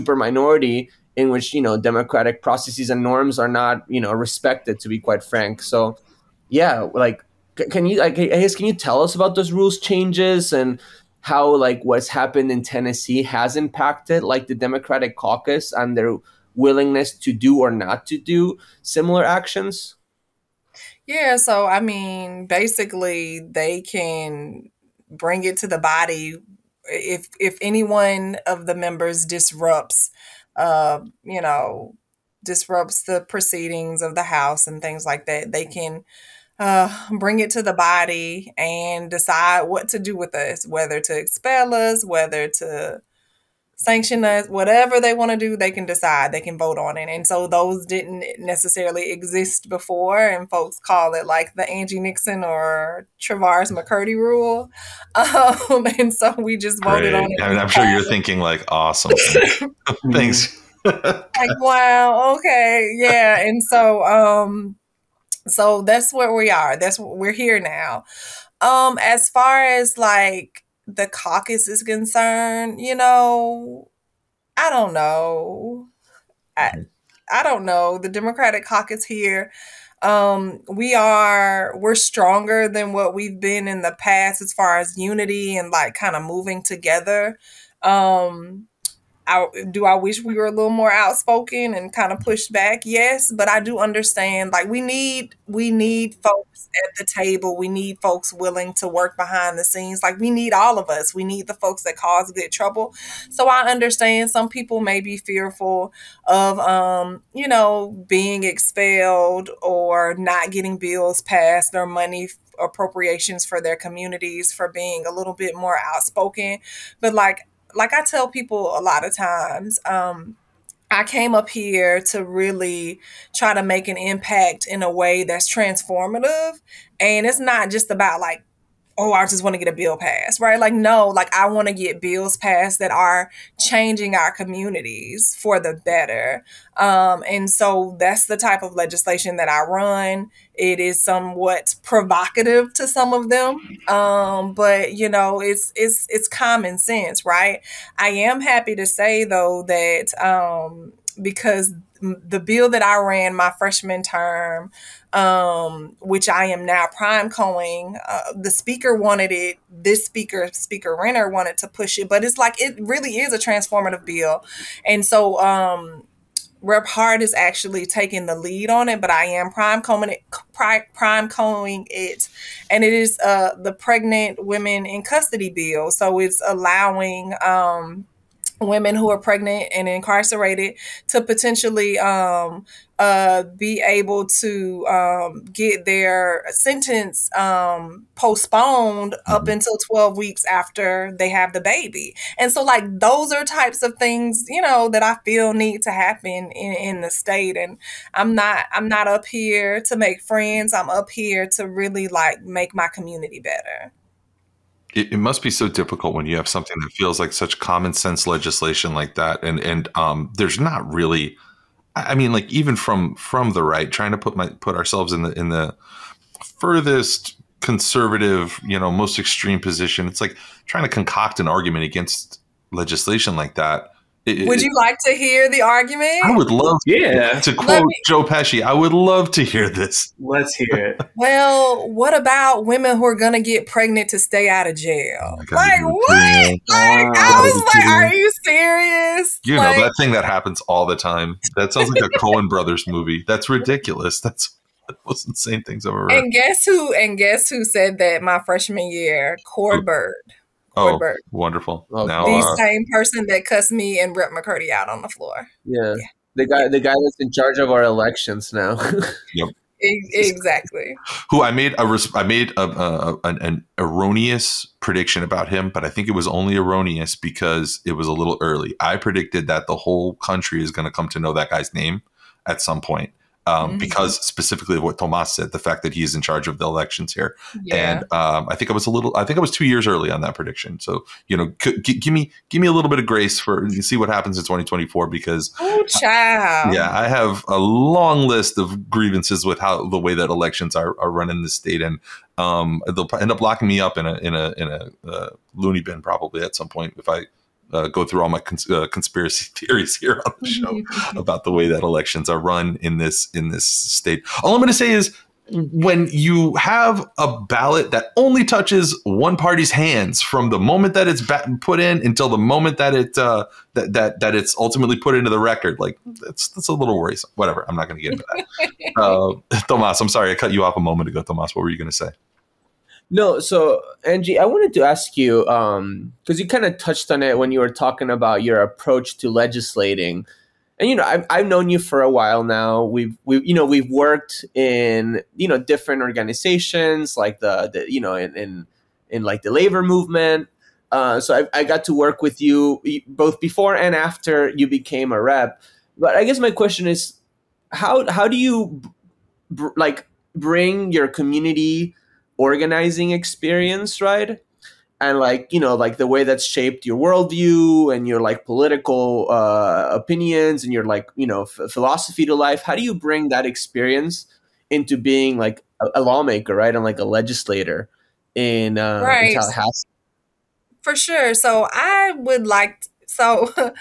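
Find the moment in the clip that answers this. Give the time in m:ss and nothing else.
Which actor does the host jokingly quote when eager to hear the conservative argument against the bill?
3:48.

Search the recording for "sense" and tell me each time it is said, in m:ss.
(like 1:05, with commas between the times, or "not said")
2:26, 3:27.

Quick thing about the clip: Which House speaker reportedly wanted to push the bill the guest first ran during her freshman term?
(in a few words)
Speaker Renner.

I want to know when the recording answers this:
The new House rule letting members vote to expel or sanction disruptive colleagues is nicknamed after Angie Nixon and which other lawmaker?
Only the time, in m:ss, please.
0:53.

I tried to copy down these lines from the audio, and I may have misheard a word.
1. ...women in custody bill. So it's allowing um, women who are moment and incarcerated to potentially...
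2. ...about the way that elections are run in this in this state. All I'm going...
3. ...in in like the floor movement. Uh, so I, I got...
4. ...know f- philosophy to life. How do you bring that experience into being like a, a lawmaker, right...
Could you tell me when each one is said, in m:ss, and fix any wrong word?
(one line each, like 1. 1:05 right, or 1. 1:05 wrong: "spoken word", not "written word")
1. 2:54 wrong: "pregnant", not "moment"
2. 5:01 right
3. 5:38 wrong: "labor", not "floor"
4. 6:01 right.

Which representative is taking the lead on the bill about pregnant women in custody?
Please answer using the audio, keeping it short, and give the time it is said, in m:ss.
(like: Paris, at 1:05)
Rep Hart, at 2:46.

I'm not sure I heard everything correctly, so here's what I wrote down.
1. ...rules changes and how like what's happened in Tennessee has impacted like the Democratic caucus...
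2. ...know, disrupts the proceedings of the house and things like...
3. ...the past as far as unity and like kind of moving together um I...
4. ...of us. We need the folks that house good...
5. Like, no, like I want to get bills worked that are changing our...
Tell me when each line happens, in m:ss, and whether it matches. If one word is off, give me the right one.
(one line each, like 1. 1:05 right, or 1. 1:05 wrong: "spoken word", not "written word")
1. 0:09 right
2. 0:31 right
3. 1:23 right
4. 1:40 wrong: "cause", not "house"
5. 2:10 wrong: "passed", not "worked".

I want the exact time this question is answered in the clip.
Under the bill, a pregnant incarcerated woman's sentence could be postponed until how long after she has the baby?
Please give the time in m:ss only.
3:09.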